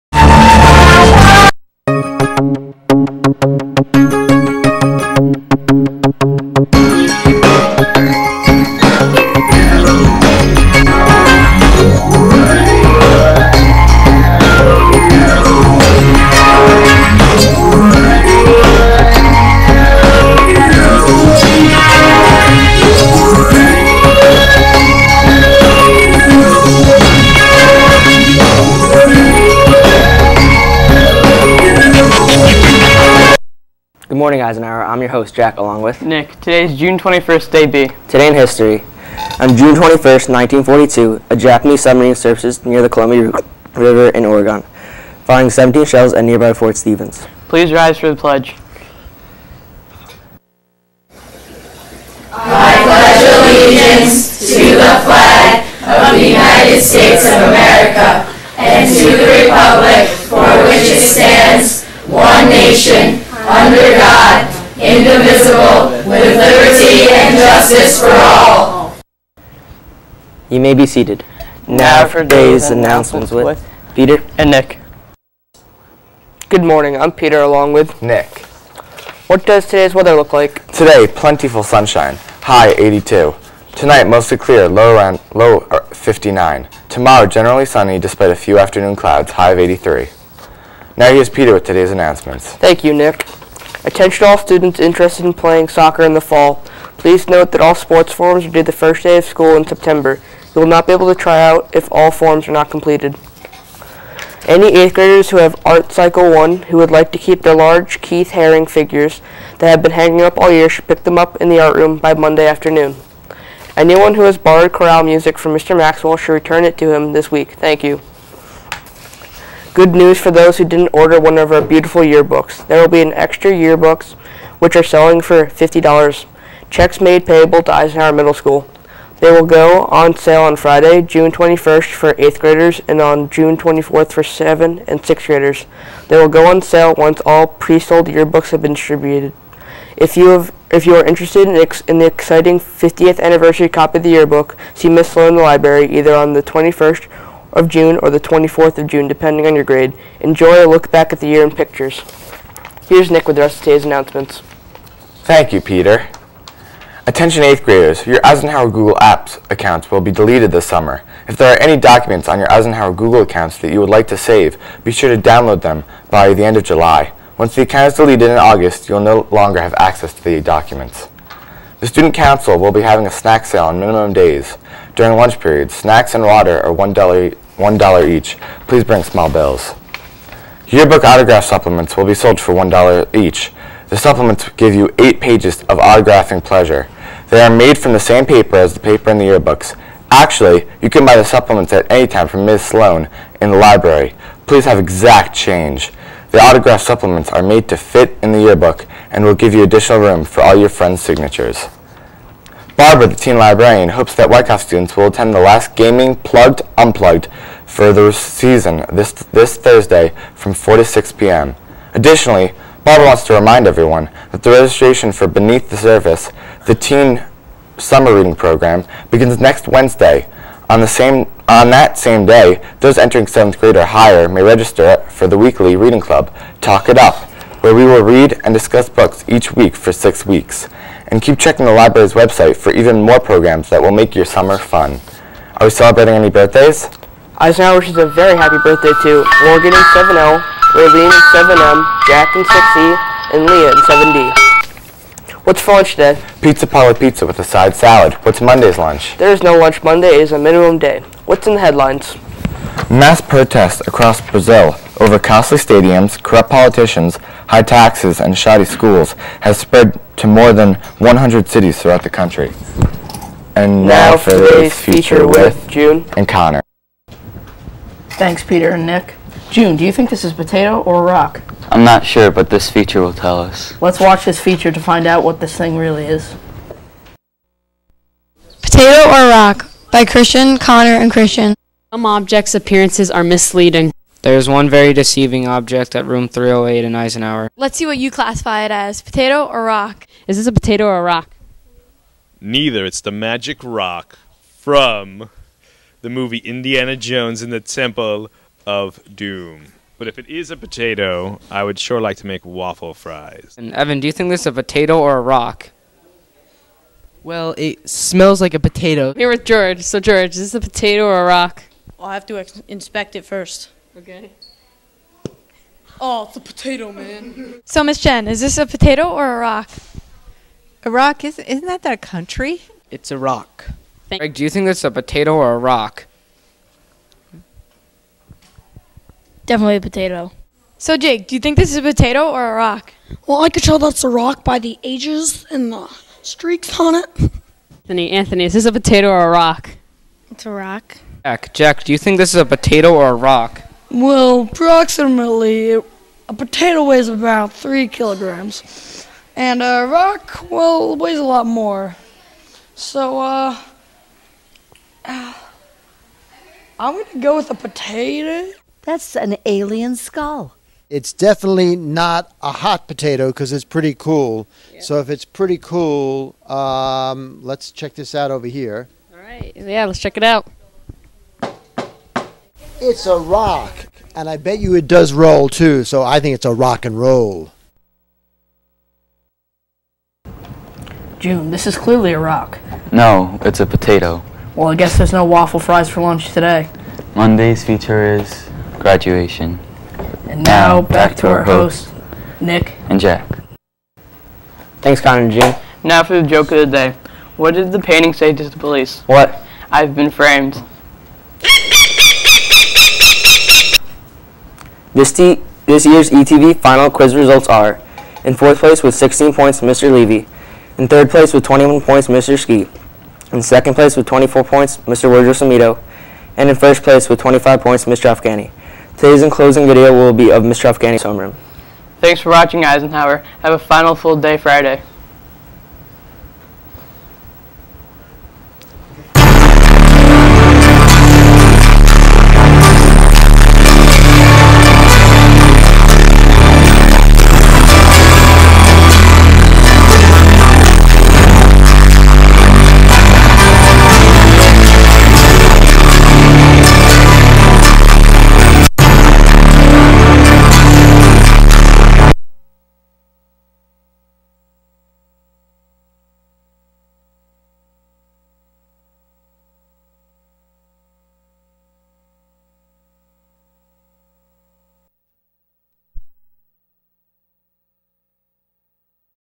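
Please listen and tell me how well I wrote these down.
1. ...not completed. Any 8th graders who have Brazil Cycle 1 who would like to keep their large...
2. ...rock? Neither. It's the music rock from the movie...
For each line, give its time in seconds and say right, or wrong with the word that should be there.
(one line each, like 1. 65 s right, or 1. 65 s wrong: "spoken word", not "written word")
1. 102 s wrong: "Art", not "Brazil"
2. 291 s wrong: "magic", not "music".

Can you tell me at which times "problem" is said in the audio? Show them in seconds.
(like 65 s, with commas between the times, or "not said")
not said.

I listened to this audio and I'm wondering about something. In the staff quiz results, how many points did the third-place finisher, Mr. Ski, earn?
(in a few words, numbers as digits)
21.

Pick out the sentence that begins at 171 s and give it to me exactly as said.
The Student Council will be having a snack sale on minimum days.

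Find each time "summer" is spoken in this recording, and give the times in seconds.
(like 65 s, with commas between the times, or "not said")
160 s, 217 s, 234 s.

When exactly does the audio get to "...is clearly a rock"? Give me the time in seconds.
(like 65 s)
381 s.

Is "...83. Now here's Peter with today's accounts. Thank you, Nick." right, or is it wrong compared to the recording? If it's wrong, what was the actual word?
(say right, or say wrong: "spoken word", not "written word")
wrong: "announcements", not "accounts".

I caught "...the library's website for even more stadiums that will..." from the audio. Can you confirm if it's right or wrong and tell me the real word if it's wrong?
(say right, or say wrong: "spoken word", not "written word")
wrong: "programs", not "stadiums".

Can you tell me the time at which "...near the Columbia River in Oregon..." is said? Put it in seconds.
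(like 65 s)
42 s.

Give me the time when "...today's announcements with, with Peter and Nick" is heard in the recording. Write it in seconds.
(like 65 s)
72 s.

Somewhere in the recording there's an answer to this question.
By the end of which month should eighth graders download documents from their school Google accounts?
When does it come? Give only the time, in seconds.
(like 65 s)
166 s.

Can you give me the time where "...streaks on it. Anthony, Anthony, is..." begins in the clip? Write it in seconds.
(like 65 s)
336 s.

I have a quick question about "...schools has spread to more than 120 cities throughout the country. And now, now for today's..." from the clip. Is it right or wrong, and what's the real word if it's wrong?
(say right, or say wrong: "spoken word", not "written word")
wrong: "100", not "120".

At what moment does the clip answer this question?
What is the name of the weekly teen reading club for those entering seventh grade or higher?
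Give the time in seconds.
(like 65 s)
226 s.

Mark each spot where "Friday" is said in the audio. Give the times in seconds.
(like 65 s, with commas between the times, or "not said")
130 s, 424 s.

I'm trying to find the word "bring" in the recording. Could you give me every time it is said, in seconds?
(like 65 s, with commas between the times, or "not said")
178 s.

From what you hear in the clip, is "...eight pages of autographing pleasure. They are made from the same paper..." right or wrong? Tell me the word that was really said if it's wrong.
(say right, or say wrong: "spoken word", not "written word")
right.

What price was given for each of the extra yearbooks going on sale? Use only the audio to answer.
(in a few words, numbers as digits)
$50.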